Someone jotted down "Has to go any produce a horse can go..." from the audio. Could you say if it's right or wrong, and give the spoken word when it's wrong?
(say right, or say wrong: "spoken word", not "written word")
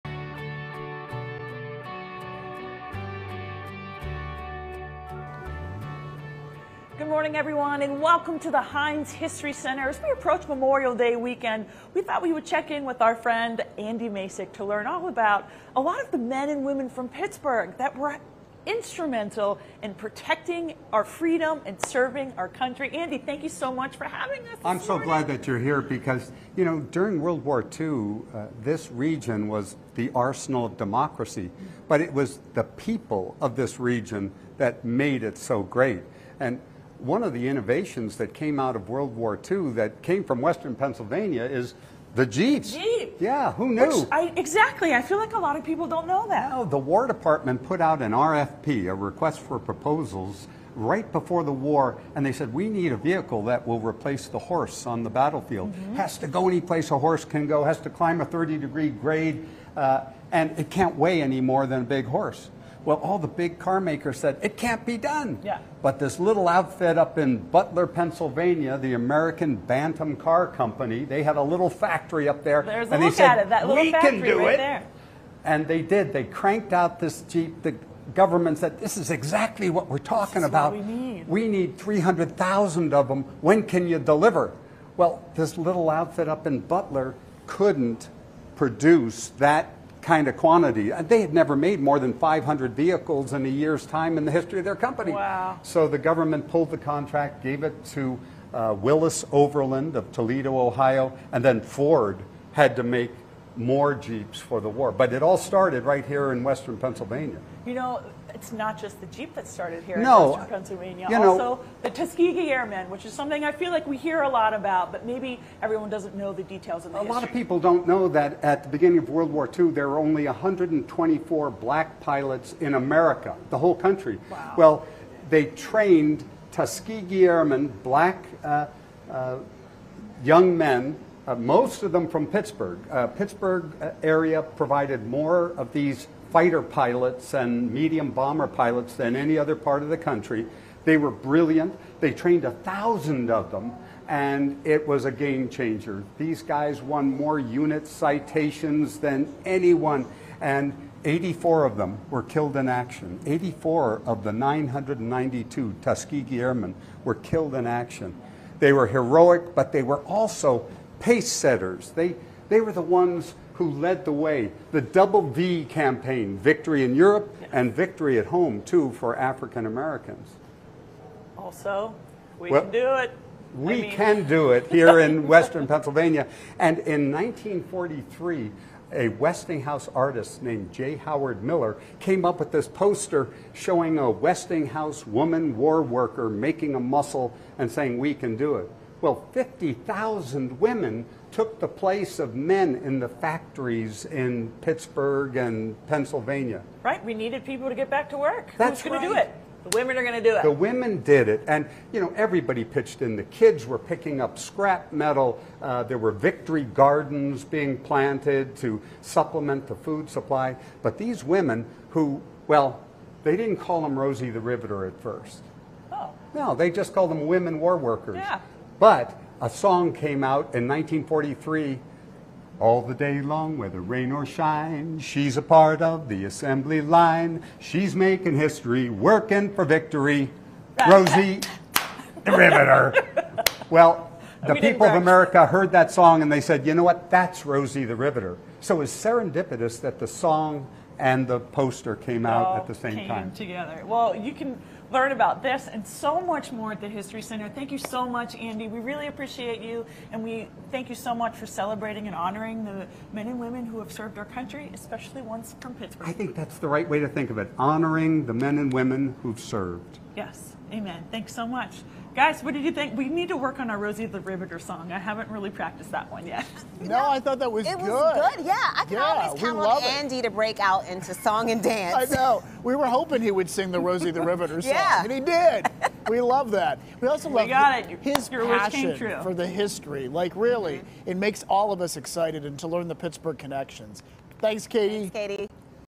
wrong: "place", not "produce".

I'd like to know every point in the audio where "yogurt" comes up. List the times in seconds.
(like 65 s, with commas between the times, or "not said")
not said.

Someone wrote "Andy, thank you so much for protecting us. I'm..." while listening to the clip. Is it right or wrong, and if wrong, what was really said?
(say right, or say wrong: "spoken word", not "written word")
wrong: "having", not "protecting".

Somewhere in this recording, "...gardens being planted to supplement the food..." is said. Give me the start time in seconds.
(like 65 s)
206 s.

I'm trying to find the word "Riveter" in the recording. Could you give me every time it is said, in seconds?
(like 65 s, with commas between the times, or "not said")
214 s, 232 s, 237 s, 264 s, 274 s.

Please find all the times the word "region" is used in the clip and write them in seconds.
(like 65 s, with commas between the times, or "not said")
28 s, 33 s.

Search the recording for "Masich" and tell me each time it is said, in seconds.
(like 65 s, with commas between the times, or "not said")
14 s.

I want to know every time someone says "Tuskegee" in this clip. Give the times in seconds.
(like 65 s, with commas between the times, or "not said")
111 s, 126 s, 155 s.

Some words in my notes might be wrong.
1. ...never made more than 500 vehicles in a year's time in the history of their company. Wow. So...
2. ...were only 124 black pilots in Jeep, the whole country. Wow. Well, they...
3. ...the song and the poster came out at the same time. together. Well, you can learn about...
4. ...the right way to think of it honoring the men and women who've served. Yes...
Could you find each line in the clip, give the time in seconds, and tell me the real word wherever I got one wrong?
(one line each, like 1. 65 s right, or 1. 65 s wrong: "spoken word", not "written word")
1. 91 s right
2. 119 s wrong: "America", not "Jeep"
3. 239 s right
4. 256 s right.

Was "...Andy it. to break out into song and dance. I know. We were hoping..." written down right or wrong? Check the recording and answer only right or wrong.
right.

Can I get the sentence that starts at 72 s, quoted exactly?
There's and a look they said, at it, that little we factory can do right it.